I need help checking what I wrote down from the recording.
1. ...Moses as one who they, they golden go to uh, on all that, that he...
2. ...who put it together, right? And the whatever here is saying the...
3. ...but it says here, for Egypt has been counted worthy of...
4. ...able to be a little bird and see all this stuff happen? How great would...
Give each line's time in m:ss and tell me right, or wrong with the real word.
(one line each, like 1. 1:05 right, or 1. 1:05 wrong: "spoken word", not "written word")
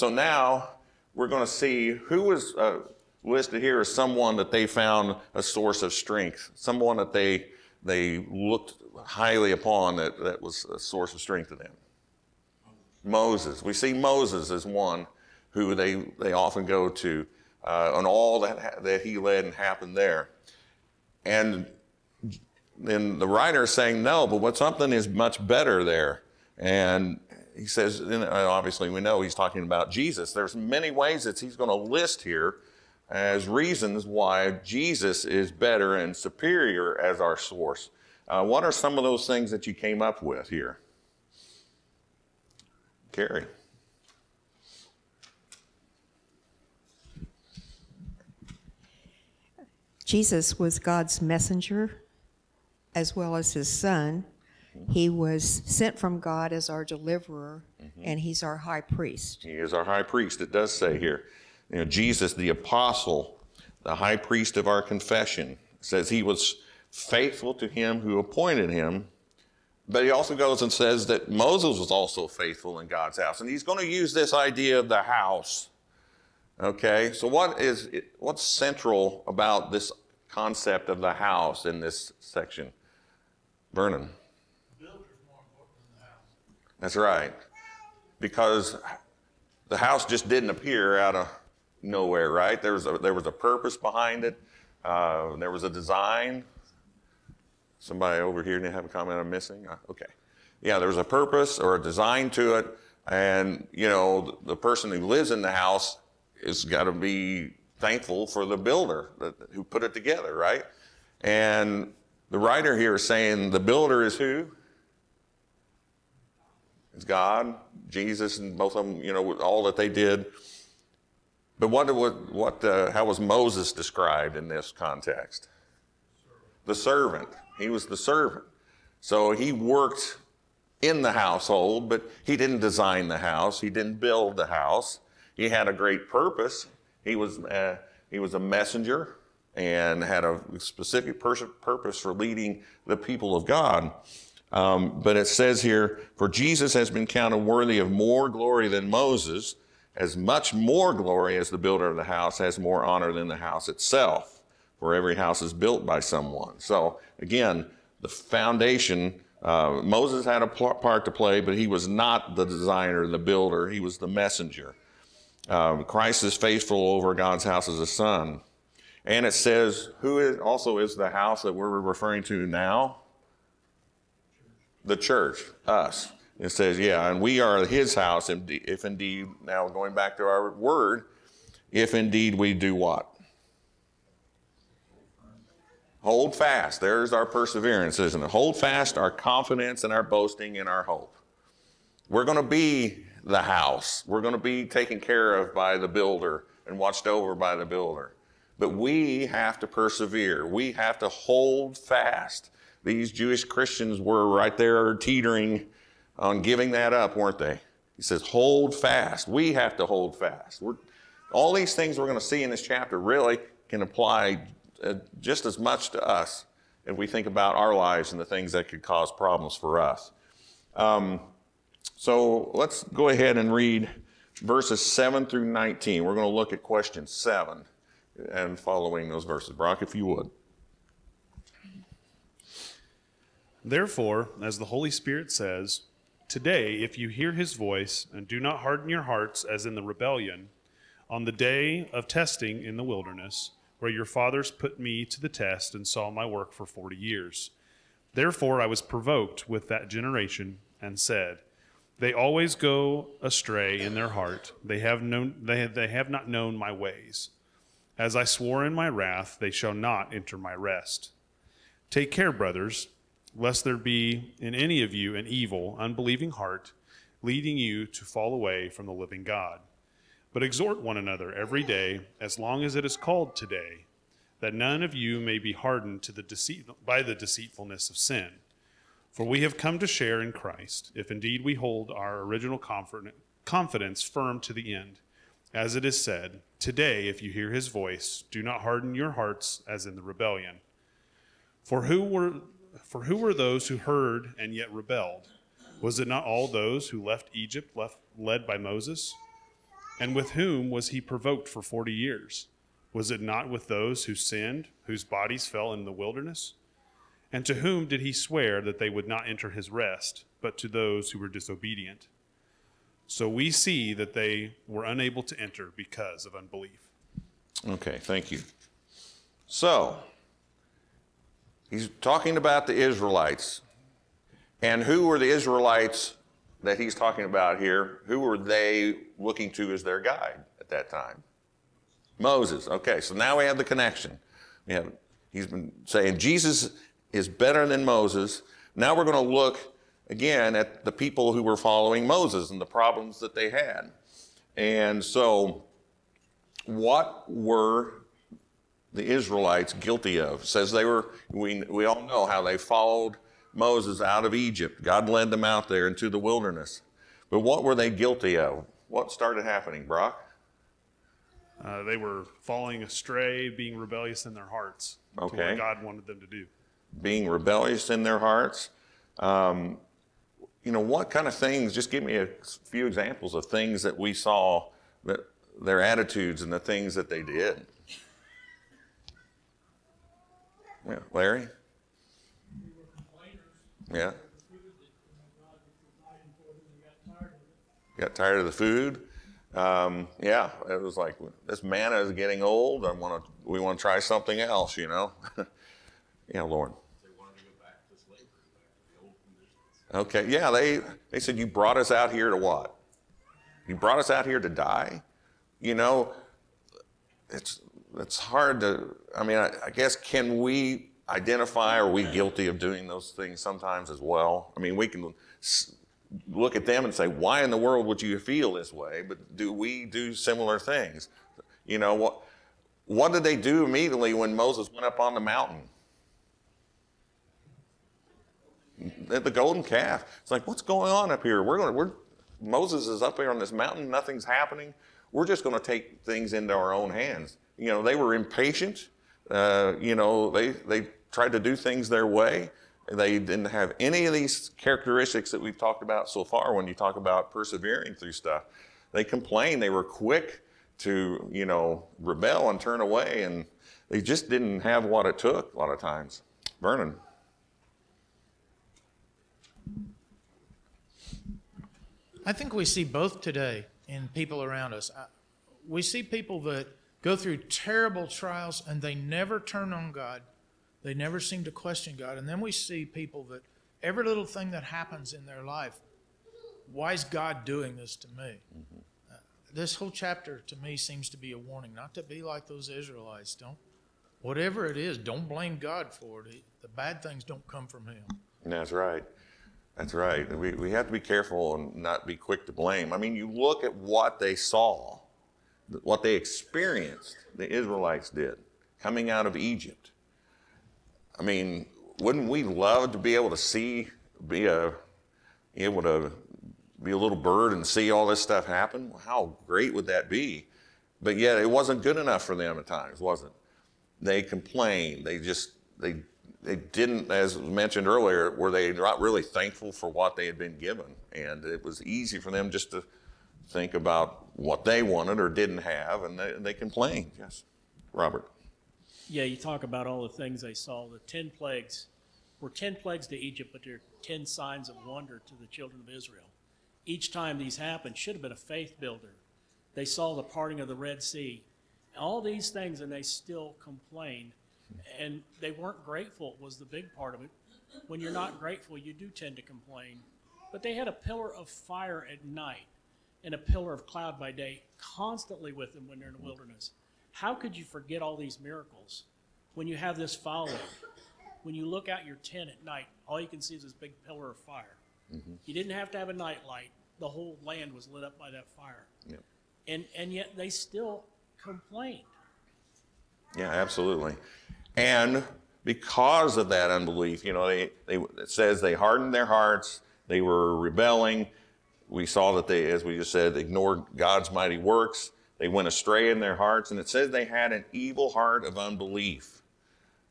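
1. 0:13 wrong: "often", not "golden"
2. 1:49 wrong: "writer", not "whatever"
3. 2:25 wrong: "Jesus", not "Egypt"
4. 8:25 right.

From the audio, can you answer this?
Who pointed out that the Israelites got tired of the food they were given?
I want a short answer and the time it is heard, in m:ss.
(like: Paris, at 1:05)
Larry, at 6:21.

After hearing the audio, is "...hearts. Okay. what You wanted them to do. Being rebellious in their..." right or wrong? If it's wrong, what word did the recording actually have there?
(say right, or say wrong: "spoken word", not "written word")
wrong: "God", not "You".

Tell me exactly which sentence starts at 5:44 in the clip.
And so, what were the Israelites guilty of?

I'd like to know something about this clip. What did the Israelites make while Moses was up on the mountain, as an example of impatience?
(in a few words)
The golden calf.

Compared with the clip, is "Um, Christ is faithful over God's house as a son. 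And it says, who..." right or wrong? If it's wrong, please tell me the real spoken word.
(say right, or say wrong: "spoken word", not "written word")
right.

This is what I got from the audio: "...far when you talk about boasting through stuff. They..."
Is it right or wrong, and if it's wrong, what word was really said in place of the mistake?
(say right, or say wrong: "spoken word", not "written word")
wrong: "persevering", not "boasting".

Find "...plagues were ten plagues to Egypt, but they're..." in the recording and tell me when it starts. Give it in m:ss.
8:51.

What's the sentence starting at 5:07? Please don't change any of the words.
And to whom did he swear that they would not enter his rest, but to those who were disobedient?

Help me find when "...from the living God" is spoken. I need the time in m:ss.
4:28.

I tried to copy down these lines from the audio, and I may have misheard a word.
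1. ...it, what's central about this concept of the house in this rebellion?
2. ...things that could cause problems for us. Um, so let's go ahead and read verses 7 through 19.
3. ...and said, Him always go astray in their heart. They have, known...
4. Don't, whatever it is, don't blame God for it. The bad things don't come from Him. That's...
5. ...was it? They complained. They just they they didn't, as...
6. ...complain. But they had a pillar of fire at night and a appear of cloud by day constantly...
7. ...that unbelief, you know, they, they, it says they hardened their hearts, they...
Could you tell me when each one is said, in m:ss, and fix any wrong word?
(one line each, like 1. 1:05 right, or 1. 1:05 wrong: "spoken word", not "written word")
1. 1:17 wrong: "section", not "rebellion"
2. 3:38 right
3. 4:10 wrong: "They", not "Him"
4. 8:03 right
5. 8:33 right
6. 9:09 wrong: "pillar", not "appear"
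7. 9:36 right.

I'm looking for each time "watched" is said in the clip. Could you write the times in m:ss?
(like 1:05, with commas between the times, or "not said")
3:16.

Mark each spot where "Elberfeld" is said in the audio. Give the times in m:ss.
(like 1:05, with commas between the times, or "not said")
not said.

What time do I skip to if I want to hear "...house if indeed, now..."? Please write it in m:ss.
2:57.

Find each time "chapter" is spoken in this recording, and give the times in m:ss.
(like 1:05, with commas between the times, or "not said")
3:32, 7:59.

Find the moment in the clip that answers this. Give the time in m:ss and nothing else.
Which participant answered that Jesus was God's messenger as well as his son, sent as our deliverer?
0:43.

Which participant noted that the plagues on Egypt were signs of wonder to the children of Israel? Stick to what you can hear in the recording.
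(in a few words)
Robert.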